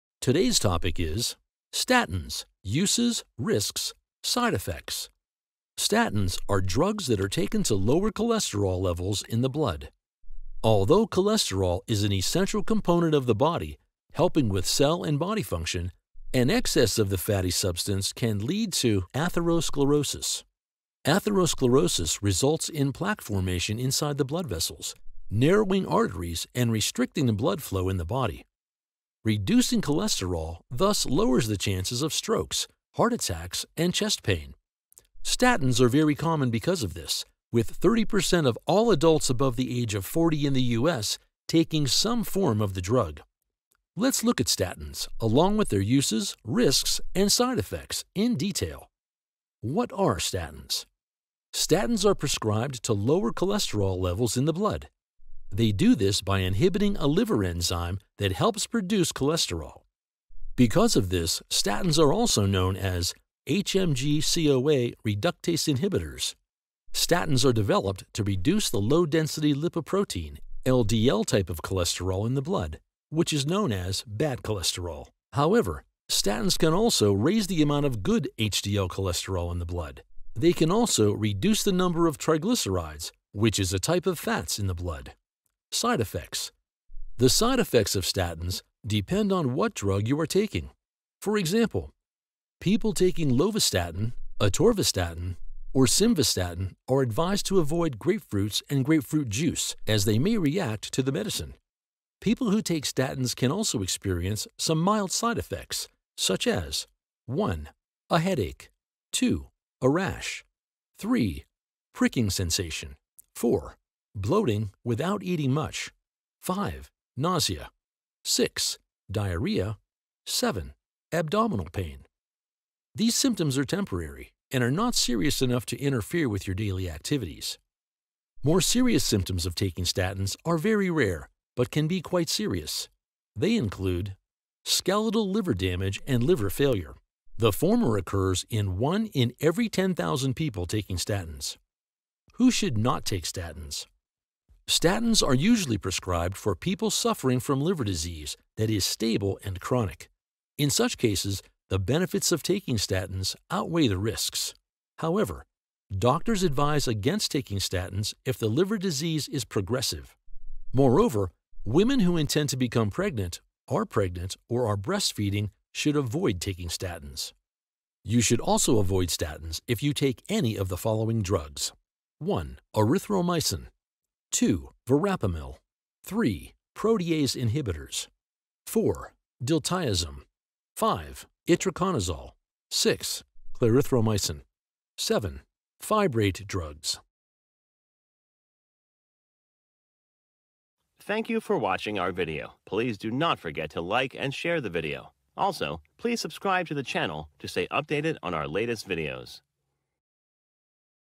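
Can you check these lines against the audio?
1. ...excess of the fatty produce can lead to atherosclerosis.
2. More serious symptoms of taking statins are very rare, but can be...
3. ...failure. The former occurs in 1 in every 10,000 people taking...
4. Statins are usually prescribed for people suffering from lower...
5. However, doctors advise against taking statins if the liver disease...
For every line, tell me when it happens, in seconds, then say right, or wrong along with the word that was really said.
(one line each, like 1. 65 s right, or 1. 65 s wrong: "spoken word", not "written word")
1. 16 s wrong: "substance", not "produce"
2. 128 s right
3. 136 s right
4. 144 s wrong: "liver", not "lower"
5. 154 s right.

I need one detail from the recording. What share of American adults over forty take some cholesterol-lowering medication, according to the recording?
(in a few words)
30%.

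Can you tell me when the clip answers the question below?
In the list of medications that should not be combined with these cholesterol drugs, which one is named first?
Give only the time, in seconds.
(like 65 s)
172 s.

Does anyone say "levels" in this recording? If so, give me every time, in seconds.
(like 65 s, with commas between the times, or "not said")
8 s, 53 s.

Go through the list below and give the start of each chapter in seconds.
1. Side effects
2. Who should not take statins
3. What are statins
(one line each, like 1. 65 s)
1. 85 s
2. 143 s
3. 50 s.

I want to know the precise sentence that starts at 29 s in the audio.
Reducing cholesterol thus lowers the chances of strokes, heart attacks, and chest pain.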